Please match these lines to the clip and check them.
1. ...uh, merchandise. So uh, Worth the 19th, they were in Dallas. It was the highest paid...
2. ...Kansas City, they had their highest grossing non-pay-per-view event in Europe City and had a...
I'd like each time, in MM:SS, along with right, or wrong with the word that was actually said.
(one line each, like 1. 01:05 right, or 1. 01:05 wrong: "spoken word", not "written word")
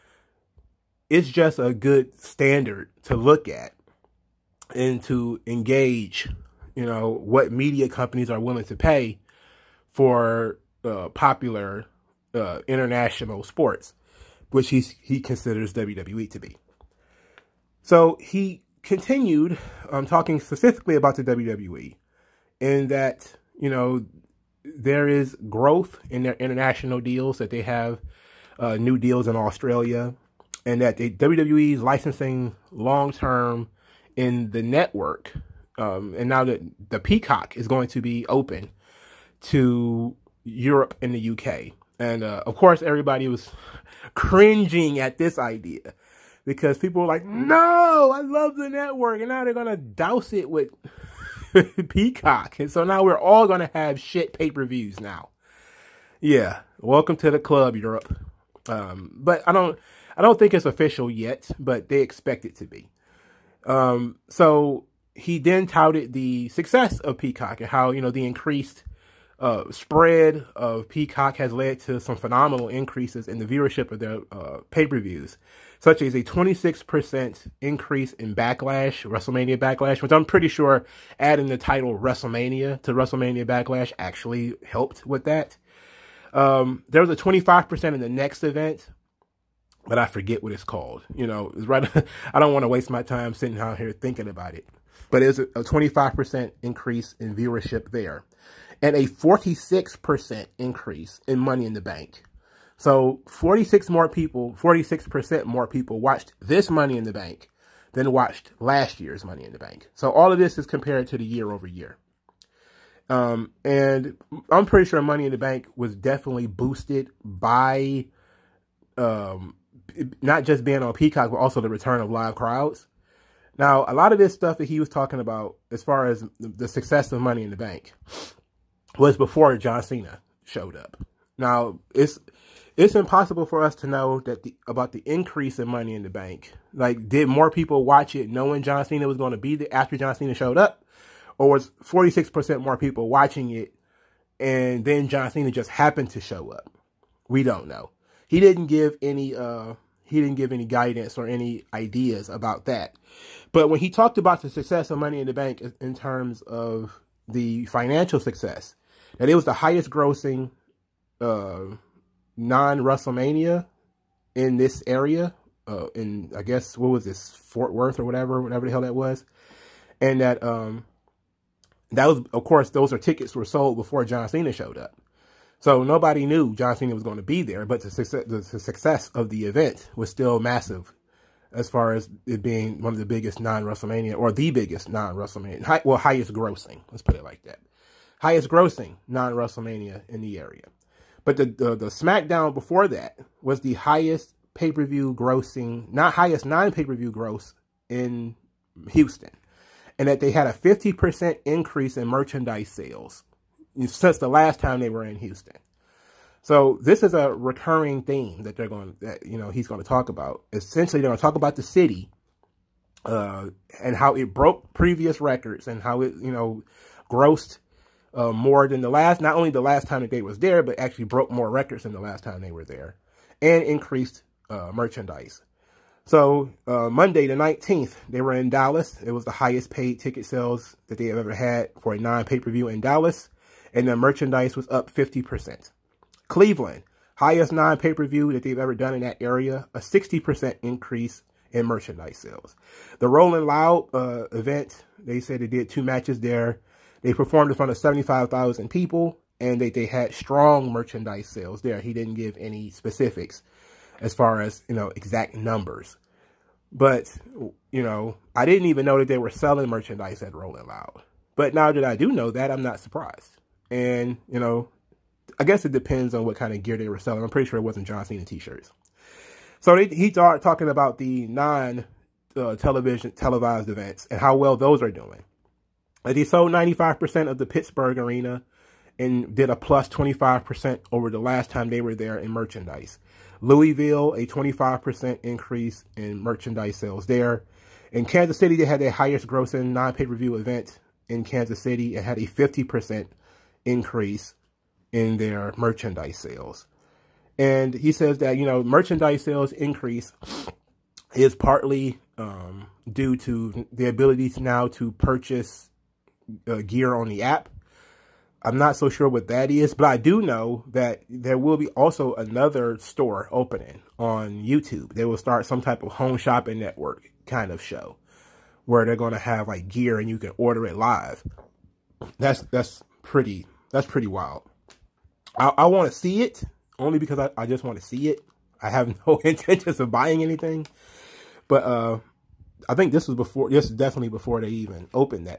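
1. 03:44 wrong: "Monday", not "Worth"
2. 04:48 wrong: "Kansas", not "Europe".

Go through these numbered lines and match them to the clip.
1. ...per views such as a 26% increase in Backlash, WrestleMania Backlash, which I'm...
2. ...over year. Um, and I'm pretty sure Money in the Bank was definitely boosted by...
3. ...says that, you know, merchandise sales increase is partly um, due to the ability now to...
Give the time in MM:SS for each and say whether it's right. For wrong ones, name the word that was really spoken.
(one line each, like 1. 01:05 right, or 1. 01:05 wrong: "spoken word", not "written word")
1. 01:14 right
2. 01:51 right
3. 04:57 right.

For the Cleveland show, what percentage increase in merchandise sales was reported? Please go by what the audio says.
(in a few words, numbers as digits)
60%.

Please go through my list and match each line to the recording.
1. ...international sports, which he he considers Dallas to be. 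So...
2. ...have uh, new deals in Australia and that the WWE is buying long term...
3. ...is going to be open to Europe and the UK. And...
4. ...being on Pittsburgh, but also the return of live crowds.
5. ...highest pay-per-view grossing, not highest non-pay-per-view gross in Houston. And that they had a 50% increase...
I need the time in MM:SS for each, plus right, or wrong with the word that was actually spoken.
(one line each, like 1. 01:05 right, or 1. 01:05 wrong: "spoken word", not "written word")
1. 00:12 wrong: "WWE", not "Dallas"
2. 00:27 wrong: "licensing", not "buying"
3. 00:37 right
4. 02:00 wrong: "Peacock", not "Pittsburgh"
5. 03:13 right.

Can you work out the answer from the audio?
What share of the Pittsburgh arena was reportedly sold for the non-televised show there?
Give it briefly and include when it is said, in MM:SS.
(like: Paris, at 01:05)
95%, at 04:36.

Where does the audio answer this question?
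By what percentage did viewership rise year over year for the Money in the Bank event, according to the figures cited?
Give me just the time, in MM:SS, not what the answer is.
01:38.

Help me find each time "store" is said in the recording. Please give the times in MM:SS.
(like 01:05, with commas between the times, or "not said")
05:12.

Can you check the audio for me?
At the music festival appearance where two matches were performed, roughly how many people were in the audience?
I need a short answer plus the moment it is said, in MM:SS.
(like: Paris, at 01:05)
75,000, at 04:07.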